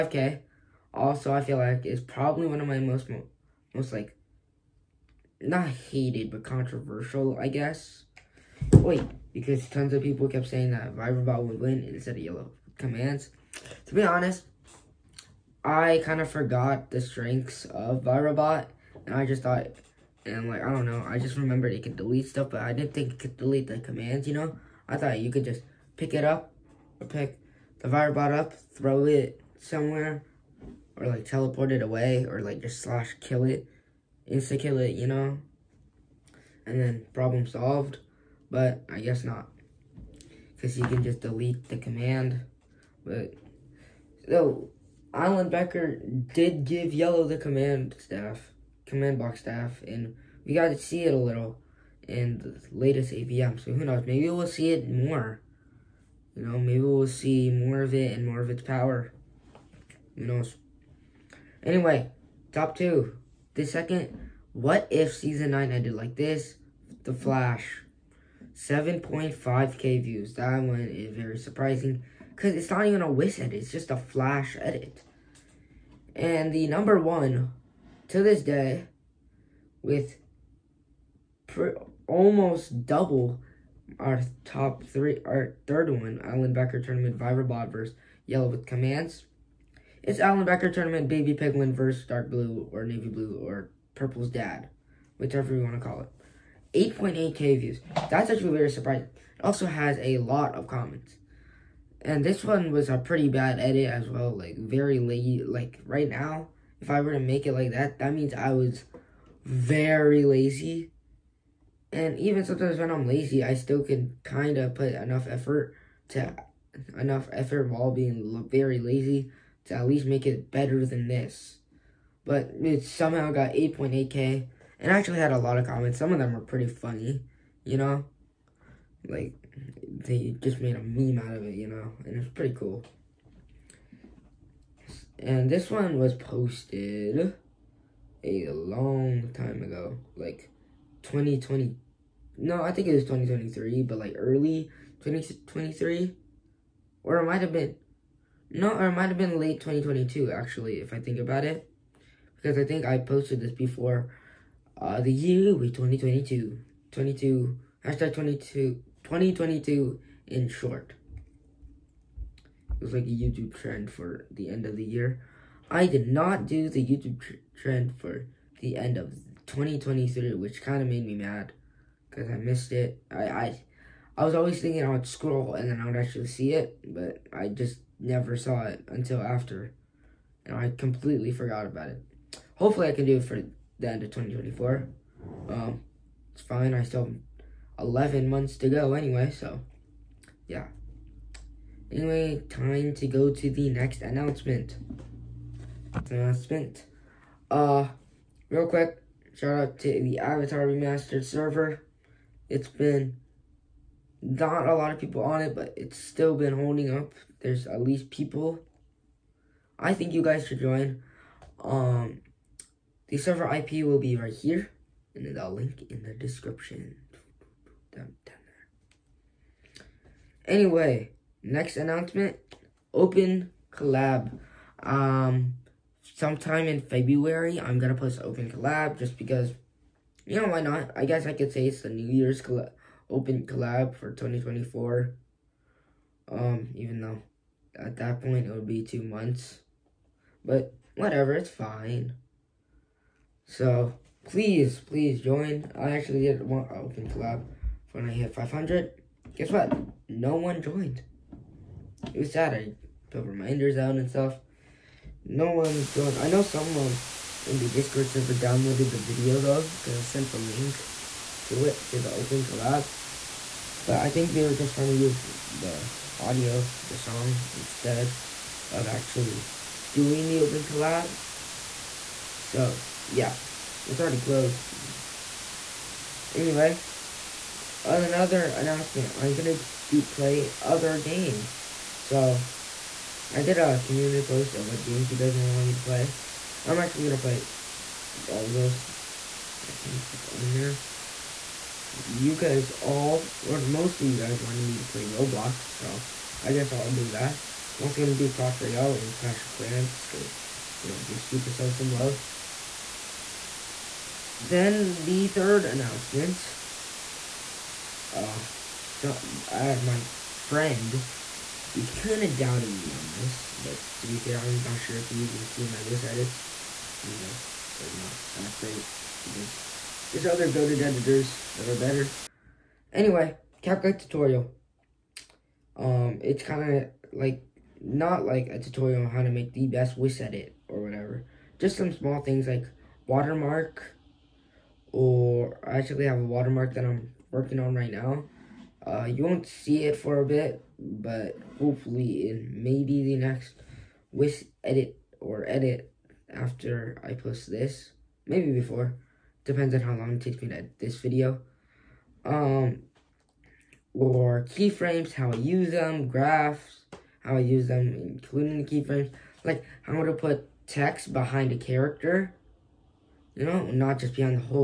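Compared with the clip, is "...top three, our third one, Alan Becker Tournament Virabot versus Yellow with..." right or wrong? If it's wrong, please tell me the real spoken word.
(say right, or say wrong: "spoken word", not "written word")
right.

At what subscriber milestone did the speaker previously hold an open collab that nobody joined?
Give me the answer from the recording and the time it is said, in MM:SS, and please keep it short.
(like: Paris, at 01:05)
500, at 04:08.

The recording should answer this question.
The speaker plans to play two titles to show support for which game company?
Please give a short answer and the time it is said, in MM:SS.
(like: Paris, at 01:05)
Supercell, at 05:01.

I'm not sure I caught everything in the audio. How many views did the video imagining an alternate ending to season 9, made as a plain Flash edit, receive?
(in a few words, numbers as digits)
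7.5k.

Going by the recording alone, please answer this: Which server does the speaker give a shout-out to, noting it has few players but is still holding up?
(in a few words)
Avatar Remastered.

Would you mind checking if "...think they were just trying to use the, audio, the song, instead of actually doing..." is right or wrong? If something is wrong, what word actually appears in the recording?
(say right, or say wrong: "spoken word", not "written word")
right.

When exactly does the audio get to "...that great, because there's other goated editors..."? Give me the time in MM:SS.
05:18.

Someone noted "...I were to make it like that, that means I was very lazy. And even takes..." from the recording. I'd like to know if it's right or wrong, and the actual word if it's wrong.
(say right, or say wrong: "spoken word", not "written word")
wrong: "sometimes", not "takes".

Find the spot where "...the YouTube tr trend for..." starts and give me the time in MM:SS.
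02:46.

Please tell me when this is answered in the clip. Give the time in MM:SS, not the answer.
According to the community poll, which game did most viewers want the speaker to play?
04:55.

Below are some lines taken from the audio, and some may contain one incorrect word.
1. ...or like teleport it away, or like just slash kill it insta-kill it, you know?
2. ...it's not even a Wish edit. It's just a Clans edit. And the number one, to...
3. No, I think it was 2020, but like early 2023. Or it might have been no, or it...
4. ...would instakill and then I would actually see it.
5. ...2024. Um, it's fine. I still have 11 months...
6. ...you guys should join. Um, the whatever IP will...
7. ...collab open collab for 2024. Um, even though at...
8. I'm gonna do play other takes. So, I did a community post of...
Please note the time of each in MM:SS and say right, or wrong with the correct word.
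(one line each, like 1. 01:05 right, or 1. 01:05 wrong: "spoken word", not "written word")
1. 00:30 right
2. 01:12 wrong: "Flash", not "Clans"
3. 02:22 wrong: "2023", not "2020"
4. 02:54 wrong: "scroll", not "instakill"
5. 03:04 right
6. 03:30 wrong: "server", not "whatever"
7. 03:52 right
8. 04:39 wrong: "games", not "takes".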